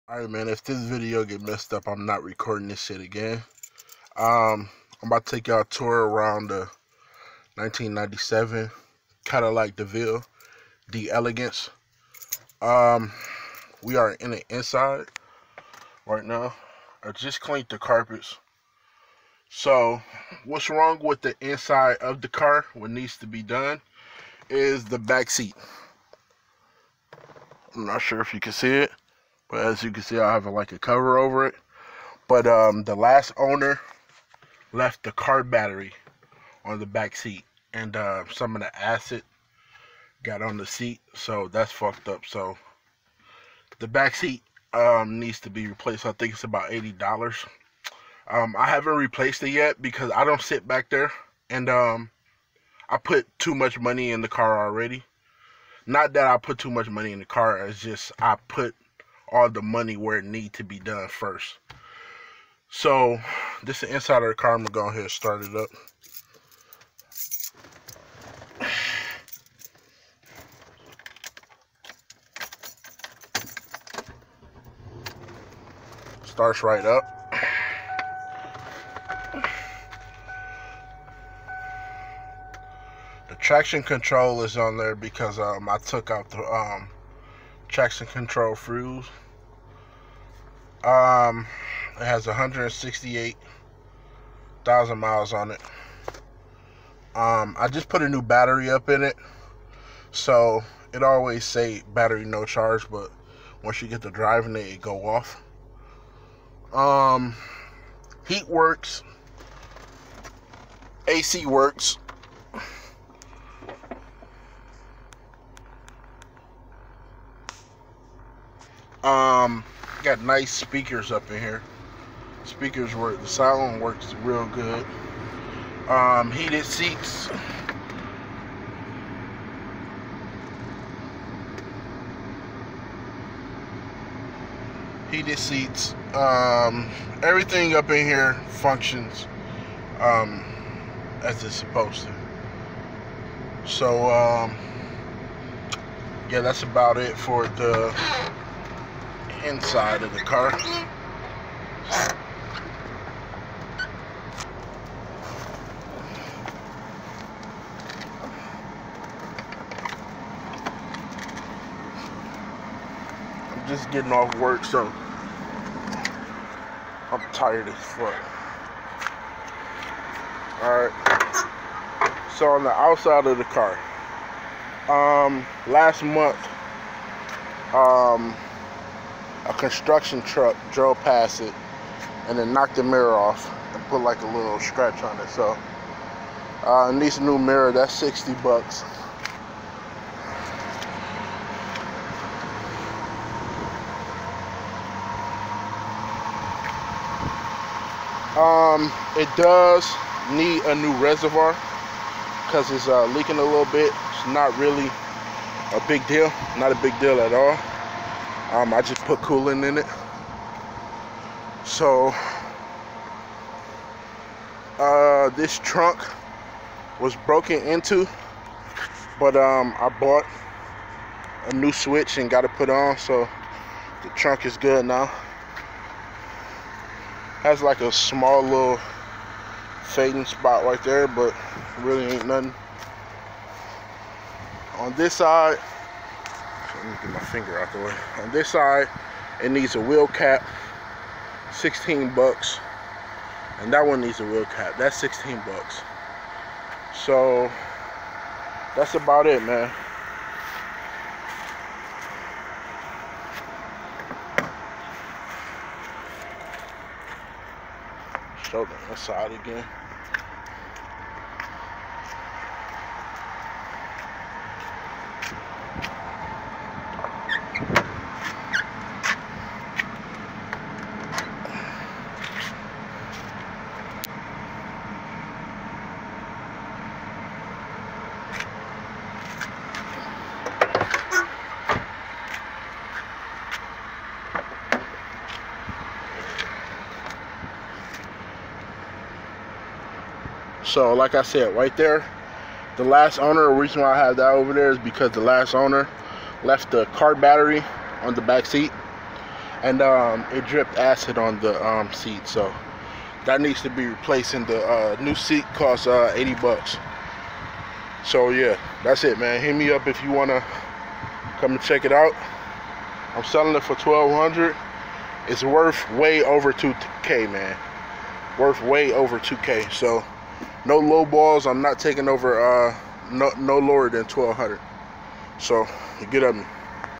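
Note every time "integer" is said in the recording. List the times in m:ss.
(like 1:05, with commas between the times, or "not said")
not said.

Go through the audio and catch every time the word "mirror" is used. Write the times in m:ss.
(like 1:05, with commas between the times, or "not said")
3:02, 3:07.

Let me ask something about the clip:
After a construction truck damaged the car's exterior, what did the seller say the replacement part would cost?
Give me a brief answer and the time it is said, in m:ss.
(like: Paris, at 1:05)
$60, at 3:07.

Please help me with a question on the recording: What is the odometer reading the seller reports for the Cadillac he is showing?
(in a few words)
168,000 miles.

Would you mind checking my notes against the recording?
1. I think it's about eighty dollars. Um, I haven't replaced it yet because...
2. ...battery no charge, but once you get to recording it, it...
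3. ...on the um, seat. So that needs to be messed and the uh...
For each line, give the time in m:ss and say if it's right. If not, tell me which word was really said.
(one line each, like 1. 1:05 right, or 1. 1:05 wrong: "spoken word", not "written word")
1. 0:46 right
2. 1:41 wrong: "driving", not "recording"
3. 5:01 wrong: "replaced", not "messed".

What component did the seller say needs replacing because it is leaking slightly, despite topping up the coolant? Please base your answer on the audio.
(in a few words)
reservoir.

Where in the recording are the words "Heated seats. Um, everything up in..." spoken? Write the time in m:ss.
2:15.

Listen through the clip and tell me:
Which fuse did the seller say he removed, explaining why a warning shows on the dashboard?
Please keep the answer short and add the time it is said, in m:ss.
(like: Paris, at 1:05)
traction control fuse, at 1:27.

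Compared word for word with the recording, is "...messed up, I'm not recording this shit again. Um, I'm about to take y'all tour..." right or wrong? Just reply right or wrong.
right.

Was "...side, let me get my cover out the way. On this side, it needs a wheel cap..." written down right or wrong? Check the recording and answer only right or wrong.
wrong.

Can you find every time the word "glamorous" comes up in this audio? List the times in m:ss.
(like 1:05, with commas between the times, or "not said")
not said.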